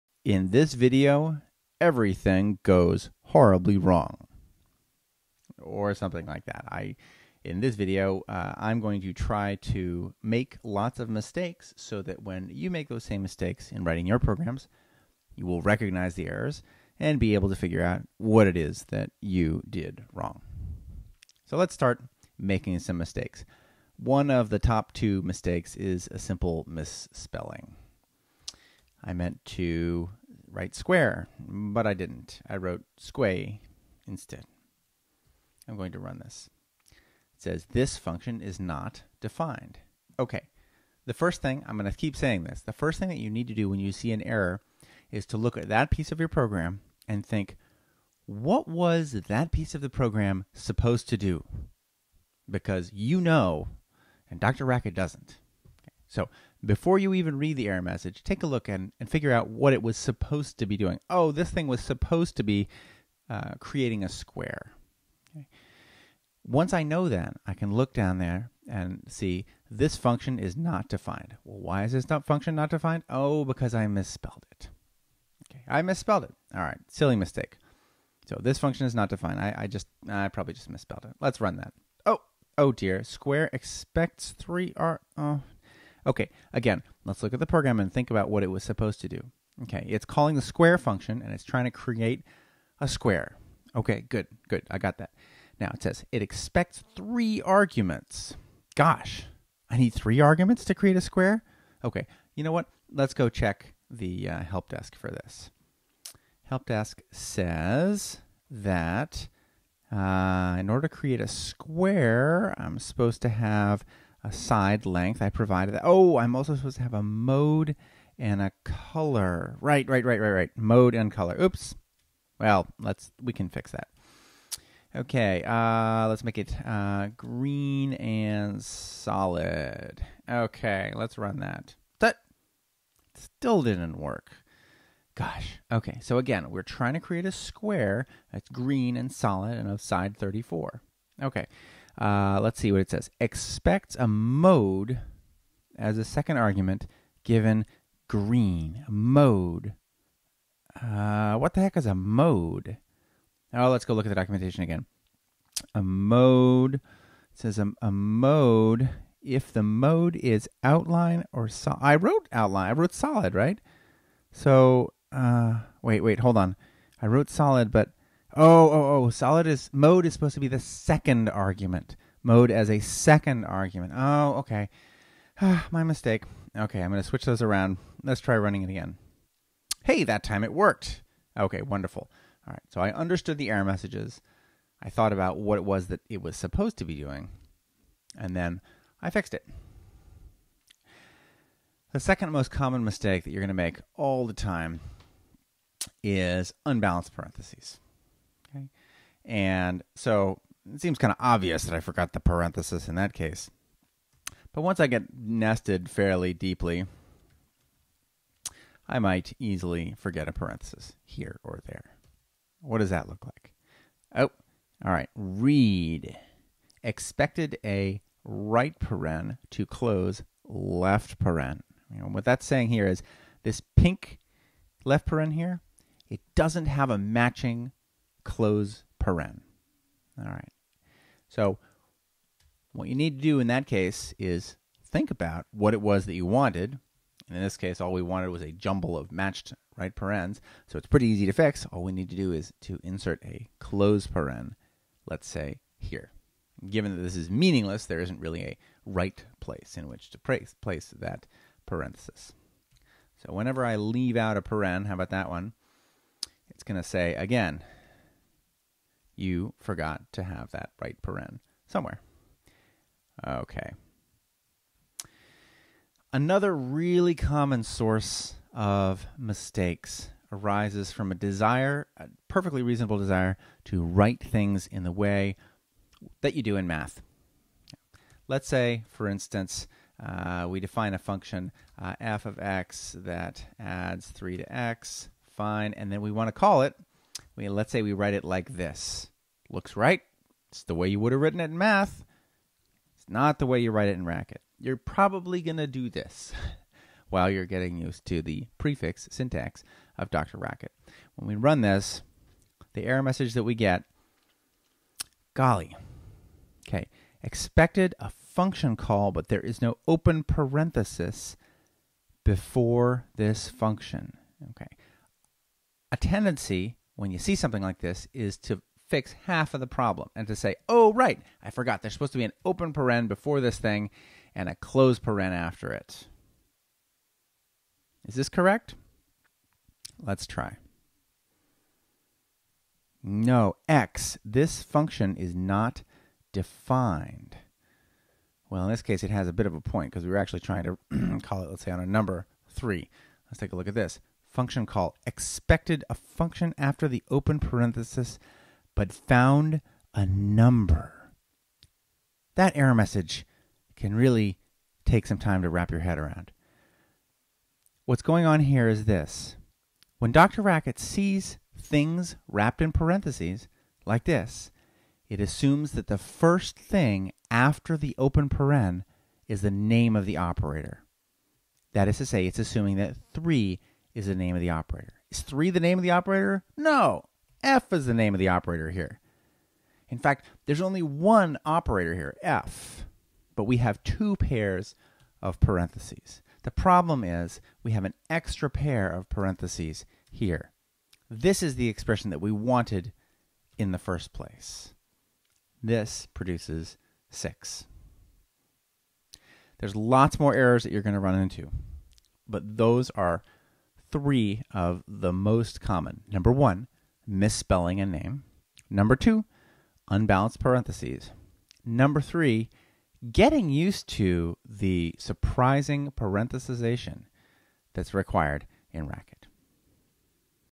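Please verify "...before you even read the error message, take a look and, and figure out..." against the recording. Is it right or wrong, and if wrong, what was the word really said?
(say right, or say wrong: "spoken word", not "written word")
right.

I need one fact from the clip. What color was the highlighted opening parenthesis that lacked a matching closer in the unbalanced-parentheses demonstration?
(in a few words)
pink.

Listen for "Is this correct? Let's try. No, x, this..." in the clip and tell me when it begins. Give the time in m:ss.
5:28.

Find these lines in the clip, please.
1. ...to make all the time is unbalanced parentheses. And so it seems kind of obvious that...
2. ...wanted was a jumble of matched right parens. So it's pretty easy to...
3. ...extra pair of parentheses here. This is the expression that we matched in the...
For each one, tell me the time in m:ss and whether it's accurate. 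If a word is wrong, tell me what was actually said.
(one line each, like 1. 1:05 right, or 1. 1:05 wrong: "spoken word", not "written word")
1. 3:13 right
2. 3:58 right
3. 6:28 wrong: "wanted", not "matched".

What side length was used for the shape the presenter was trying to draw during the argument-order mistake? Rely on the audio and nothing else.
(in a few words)
34.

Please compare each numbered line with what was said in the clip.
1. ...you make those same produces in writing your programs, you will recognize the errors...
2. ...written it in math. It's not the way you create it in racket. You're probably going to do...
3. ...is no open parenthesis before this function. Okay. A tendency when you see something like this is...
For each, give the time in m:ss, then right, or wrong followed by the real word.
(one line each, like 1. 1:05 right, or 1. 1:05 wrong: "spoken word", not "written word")
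1. 0:12 wrong: "mistakes", not "produces"
2. 4:51 wrong: "write", not "create"
3. 5:09 right.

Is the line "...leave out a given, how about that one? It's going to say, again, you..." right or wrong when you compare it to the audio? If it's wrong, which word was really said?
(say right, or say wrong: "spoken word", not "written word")
wrong: "paren", not "given".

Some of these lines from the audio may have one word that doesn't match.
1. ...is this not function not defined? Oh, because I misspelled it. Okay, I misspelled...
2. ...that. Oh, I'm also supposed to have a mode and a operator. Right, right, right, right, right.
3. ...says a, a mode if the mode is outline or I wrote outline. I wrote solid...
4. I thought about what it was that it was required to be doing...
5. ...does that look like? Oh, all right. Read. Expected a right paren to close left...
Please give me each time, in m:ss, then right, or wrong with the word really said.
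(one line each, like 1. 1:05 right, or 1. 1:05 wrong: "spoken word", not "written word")
1. 1:11 right
2. 1:55 wrong: "color", not "operator"
3. 2:37 right
4. 3:04 wrong: "supposed", not "required"
5. 3:32 right.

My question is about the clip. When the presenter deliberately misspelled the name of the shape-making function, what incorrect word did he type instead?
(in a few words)
squay.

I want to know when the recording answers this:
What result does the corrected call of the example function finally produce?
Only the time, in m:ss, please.
6:37.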